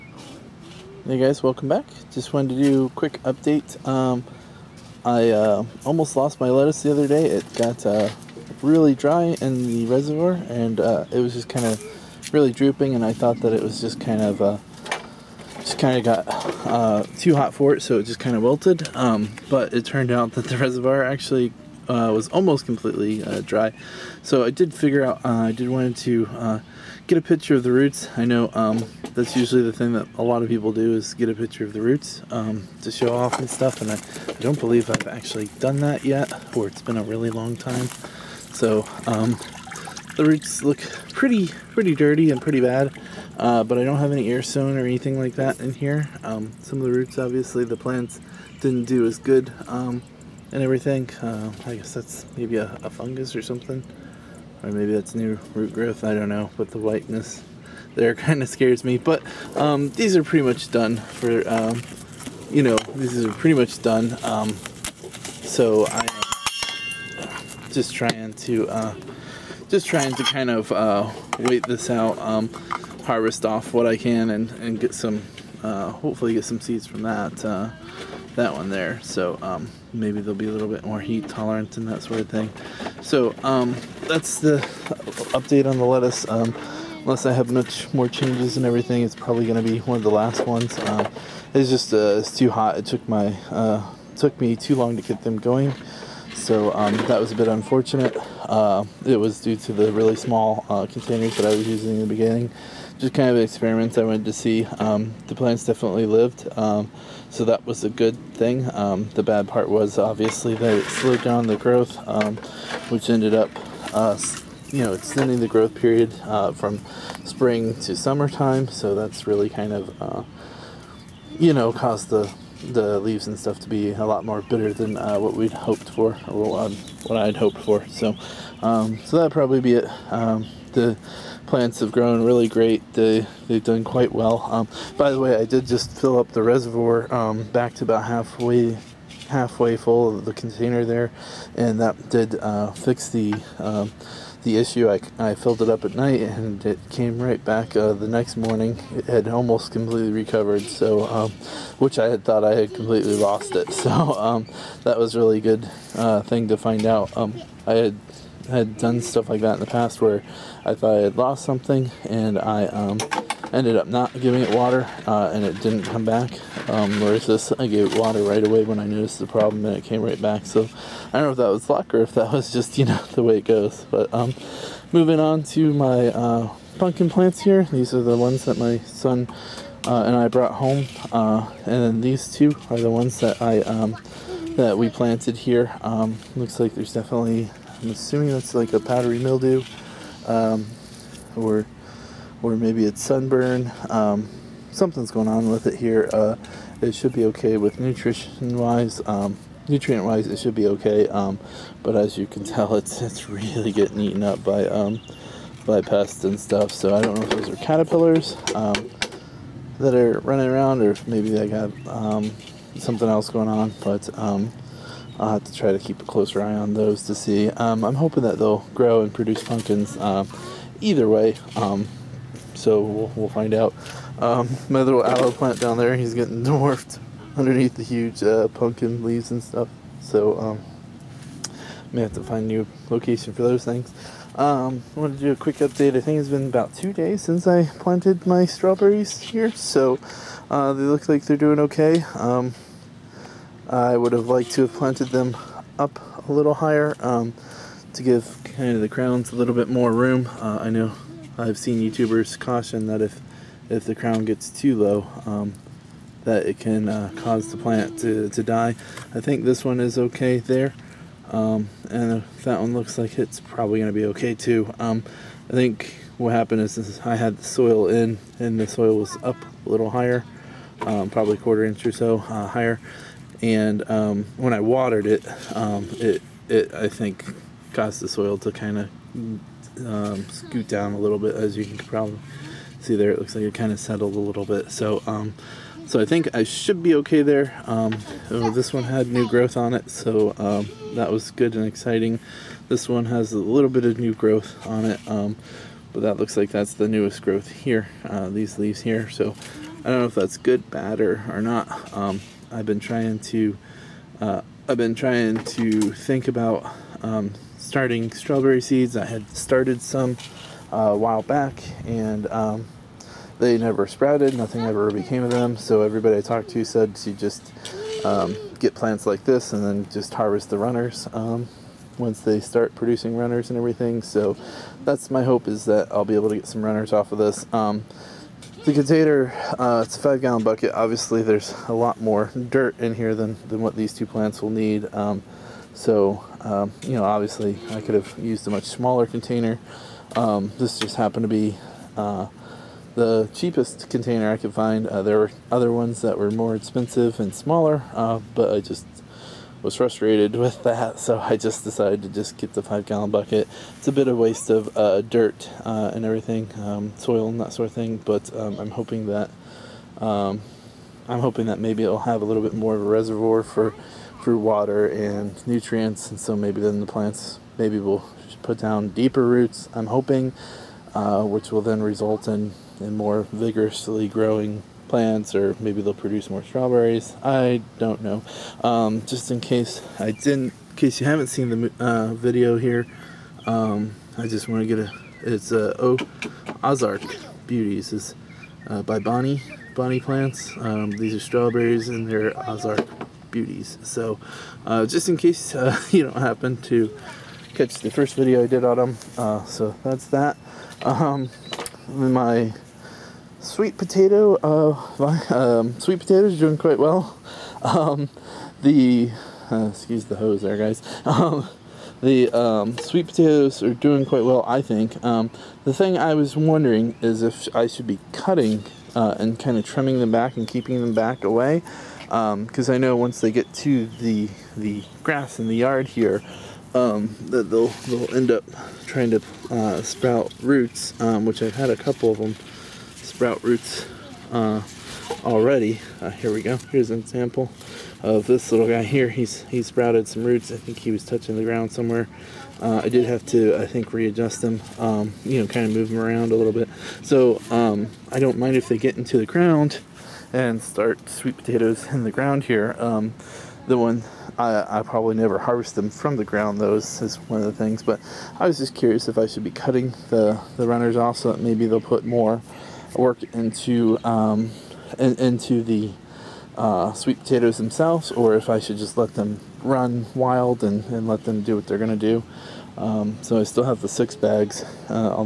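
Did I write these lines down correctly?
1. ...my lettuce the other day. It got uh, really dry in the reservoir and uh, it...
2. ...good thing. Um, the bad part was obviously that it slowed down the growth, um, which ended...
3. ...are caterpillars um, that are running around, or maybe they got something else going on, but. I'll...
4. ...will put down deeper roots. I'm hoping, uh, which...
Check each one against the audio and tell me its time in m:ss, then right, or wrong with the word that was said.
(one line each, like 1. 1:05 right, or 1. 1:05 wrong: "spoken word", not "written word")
1. 0:06 right
2. 1:47 right
3. 3:27 right
4. 6:07 right.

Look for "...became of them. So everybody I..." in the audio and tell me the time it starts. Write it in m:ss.
5:14.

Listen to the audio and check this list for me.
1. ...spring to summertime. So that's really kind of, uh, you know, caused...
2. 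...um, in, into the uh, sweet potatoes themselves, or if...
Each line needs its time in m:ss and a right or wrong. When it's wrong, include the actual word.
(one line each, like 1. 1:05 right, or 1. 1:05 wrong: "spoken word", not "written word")
1. 1:57 right
2. 7:44 right.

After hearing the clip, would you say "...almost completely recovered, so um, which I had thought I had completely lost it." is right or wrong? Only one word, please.
right.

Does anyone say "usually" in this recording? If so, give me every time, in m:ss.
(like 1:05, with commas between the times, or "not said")
0:29.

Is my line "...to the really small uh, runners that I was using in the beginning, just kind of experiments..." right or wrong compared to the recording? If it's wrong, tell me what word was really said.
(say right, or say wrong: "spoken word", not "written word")
wrong: "containers", not "runners".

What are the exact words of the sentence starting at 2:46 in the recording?
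Um, whereas this, I gave it water right away when I noticed the problem and it came right back.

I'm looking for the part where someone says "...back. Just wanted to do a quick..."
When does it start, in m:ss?
0:01.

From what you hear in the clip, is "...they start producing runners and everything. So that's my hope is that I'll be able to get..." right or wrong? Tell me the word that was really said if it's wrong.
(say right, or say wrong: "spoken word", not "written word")
right.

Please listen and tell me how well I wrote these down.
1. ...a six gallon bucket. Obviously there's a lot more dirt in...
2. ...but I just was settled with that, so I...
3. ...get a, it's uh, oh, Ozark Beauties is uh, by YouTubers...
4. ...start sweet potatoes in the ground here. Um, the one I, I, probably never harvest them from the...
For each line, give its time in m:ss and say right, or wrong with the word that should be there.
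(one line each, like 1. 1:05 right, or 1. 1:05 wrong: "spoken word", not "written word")
1. 5:29 wrong: "five", not "six"
2. 5:48 wrong: "frustrated", not "settled"
3. 6:24 wrong: "Bonnie", not "YouTubers"
4. 7:30 right.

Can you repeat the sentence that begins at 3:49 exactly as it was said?
So um, may have to find a new location for those things.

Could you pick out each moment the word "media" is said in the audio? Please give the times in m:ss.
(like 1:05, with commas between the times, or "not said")
not said.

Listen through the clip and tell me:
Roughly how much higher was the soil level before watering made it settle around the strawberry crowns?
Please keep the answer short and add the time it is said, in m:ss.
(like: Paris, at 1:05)
a quarter inch, at 4:31.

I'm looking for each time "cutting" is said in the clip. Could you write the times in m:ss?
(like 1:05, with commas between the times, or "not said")
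6:58, 7:39.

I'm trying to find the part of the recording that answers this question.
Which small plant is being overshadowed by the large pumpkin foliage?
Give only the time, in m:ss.
3:45.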